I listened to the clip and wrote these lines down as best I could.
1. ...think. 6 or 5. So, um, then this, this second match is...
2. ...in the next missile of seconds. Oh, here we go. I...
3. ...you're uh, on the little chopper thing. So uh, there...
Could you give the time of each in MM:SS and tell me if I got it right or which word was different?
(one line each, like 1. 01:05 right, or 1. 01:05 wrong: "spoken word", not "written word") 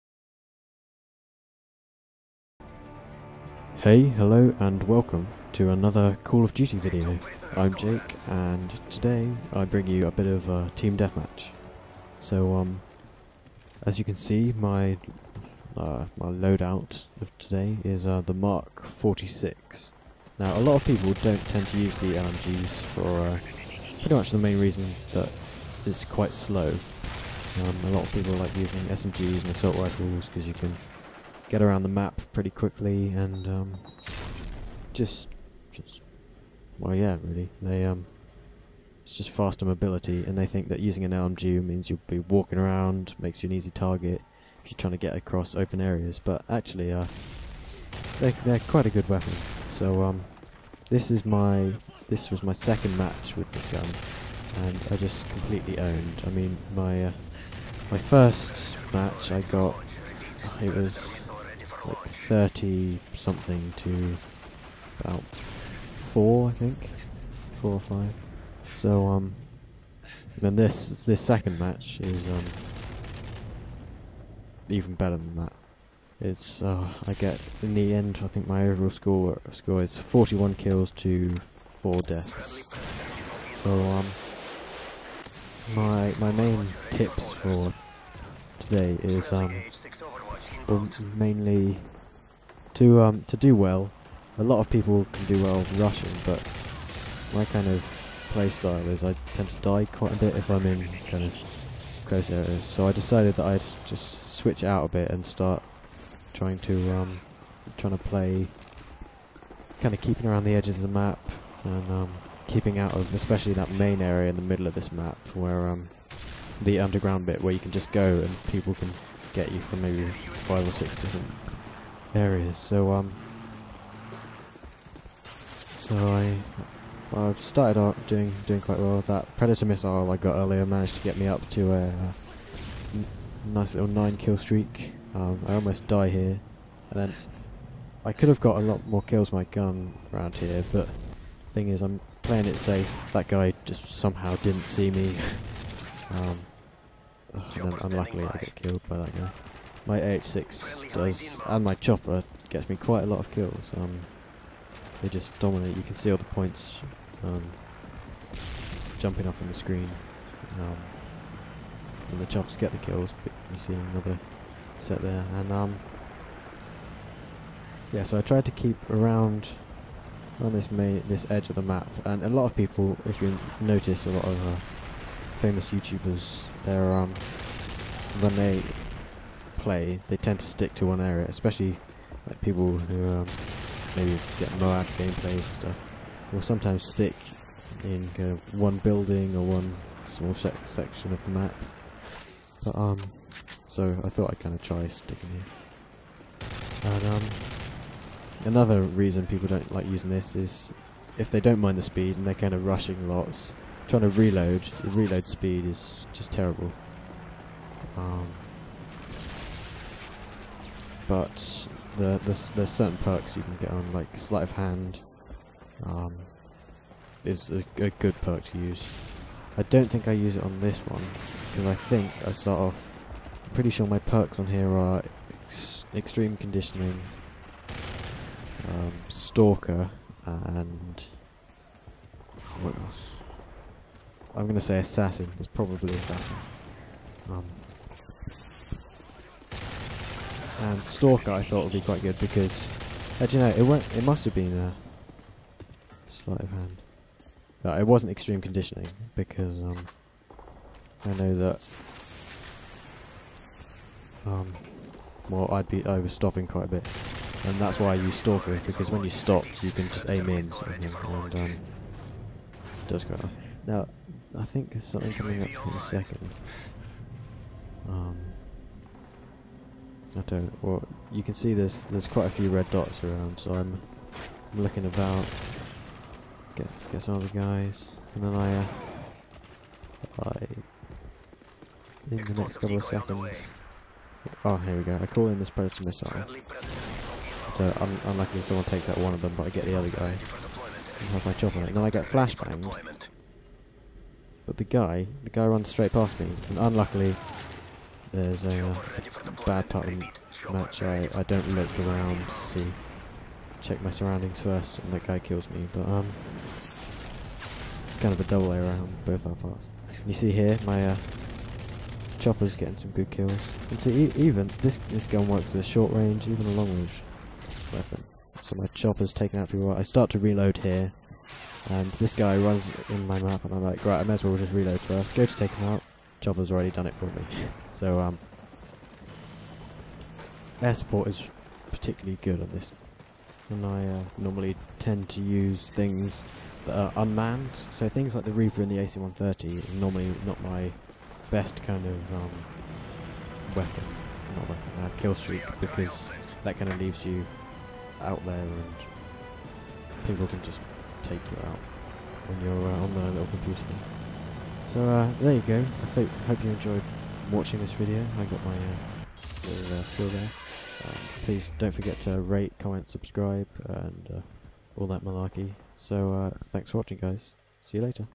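1. 01:06 wrong: "4", not "6"
2. 04:42 wrong: "couple", not "missile"
3. 05:52 wrong: "computer", not "chopper".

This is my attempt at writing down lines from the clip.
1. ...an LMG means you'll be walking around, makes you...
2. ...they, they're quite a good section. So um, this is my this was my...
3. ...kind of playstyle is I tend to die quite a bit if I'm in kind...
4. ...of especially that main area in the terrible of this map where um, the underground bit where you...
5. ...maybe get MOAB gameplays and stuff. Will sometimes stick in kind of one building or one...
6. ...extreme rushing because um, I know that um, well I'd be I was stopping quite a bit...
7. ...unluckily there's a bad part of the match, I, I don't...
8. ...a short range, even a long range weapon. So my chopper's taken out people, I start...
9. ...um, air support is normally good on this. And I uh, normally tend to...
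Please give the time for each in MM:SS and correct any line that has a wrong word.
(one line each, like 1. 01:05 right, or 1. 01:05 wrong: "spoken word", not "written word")
1. 00:41 right
2. 00:48 wrong: "weapon", not "section"
3. 01:37 right
4. 01:52 wrong: "middle", not "terrible"
5. 03:03 right
6. 04:08 wrong: "conditioning", not "rushing"
7. 04:56 right
8. 05:15 right
9. 05:27 wrong: "particularly", not "normally".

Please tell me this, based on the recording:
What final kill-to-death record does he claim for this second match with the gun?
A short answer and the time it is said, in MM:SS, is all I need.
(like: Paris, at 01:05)
41 kills to 4 deaths, at 01:19.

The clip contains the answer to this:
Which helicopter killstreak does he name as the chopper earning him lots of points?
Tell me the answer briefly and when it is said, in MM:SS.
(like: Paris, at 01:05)
AH-6, at 02:29.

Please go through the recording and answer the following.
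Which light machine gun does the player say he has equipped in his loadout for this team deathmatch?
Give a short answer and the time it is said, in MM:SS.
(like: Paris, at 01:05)
Mark 46, at 00:18.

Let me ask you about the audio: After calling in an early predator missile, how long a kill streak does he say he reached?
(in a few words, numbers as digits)
9.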